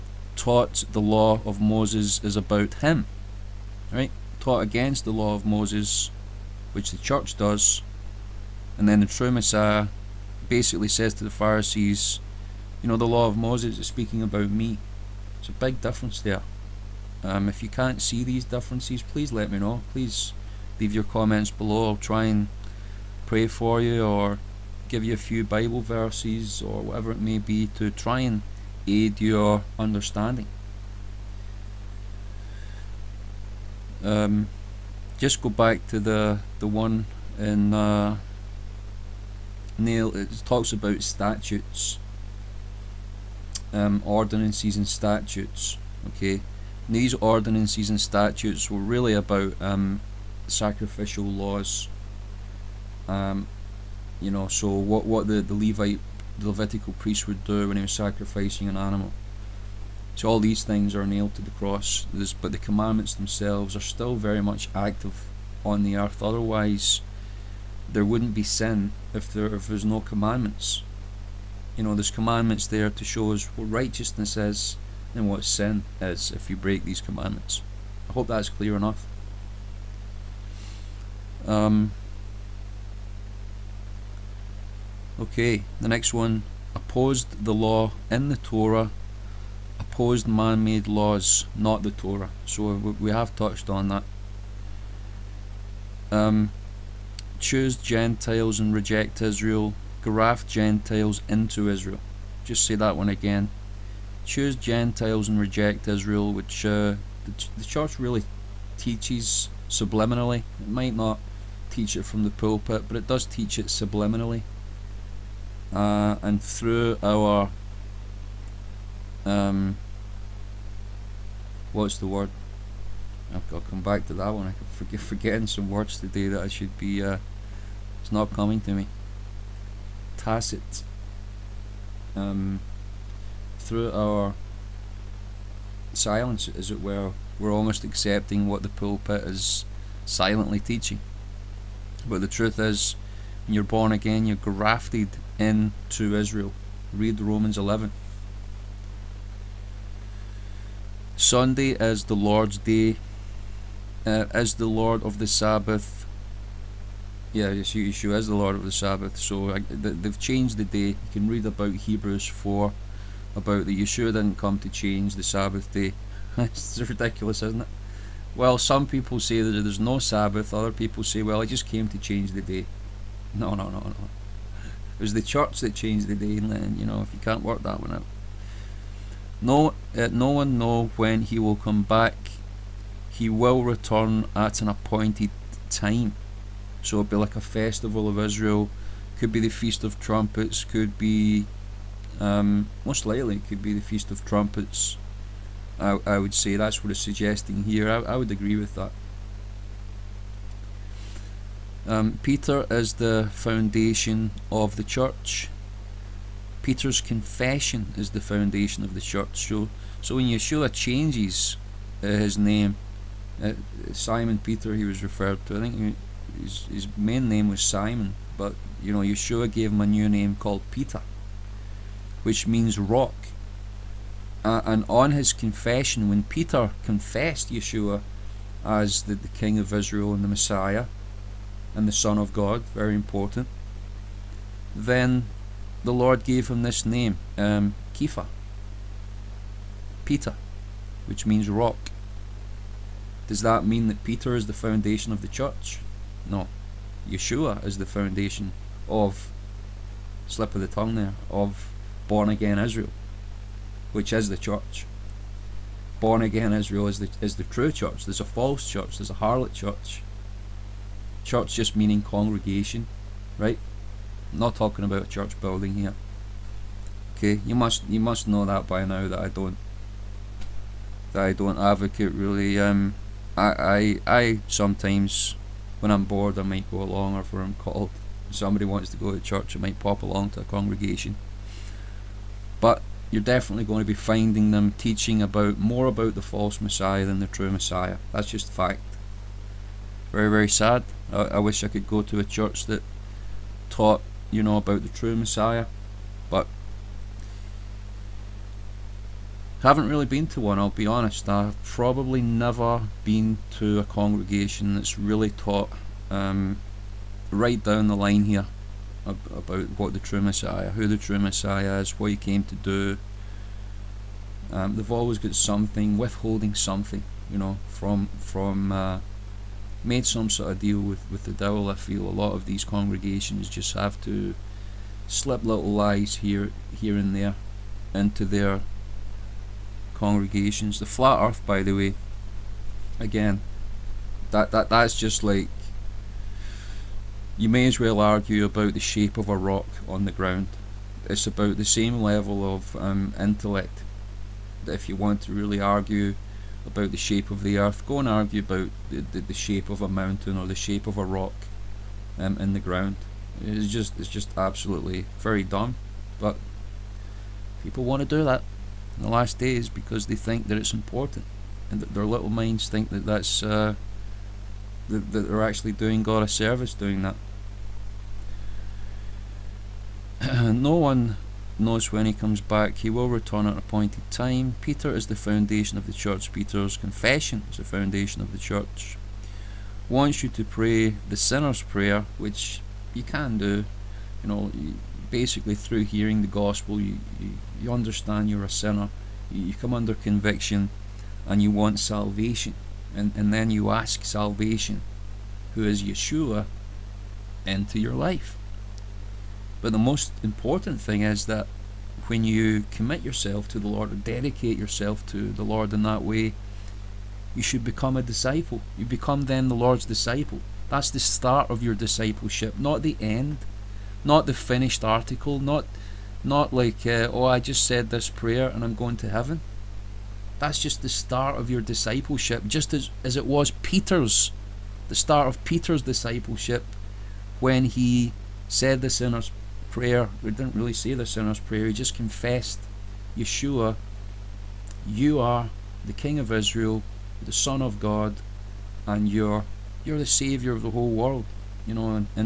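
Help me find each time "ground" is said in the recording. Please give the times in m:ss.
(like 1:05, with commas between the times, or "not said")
5:40, 5:52.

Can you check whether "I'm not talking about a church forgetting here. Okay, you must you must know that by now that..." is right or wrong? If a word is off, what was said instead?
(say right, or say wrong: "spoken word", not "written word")
wrong: "building", not "forgetting".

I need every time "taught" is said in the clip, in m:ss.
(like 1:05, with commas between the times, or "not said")
0:00, 0:04, 4:53, 5:05.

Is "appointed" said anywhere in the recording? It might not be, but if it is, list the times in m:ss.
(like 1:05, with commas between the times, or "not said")
3:04, 6:13.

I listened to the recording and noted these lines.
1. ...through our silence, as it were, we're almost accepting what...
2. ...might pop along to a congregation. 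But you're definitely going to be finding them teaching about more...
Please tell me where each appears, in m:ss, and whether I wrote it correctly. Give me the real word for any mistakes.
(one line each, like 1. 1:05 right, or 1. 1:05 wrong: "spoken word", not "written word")
1. 2:13 right
2. 4:39 right.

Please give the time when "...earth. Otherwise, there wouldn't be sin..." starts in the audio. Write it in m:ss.
1:05.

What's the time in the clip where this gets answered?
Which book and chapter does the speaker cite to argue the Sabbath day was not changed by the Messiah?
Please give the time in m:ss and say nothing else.
2:41.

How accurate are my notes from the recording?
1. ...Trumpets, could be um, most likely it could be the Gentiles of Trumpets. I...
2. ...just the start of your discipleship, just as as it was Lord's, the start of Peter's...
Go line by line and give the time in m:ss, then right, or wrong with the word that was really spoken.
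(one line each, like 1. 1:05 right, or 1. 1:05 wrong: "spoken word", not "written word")
1. 3:09 wrong: "Feast", not "Gentiles"
2. 7:00 wrong: "Peter", not "Lord".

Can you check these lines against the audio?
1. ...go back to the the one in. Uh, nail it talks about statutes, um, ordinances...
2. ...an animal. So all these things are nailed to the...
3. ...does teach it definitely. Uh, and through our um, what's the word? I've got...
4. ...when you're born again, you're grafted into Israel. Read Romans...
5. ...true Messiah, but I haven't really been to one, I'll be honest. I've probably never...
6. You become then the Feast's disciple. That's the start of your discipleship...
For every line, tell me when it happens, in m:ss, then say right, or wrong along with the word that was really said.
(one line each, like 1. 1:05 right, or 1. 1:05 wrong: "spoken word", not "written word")
1. 0:35 right
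2. 0:58 right
3. 1:53 wrong: "subliminally", not "definitely"
4. 2:23 right
5. 4:54 right
6. 6:48 wrong: "Lord", not "Feast".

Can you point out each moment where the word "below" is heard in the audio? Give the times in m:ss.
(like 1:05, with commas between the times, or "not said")
0:21.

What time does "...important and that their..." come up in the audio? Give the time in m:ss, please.
6:00.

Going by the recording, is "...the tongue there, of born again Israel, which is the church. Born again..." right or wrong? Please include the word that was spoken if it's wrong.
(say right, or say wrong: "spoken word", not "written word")
right.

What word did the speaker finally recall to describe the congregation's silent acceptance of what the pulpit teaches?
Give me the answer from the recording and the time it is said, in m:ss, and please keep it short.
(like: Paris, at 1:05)
Tacit, at 2:10.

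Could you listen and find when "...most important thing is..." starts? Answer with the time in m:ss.
6:39.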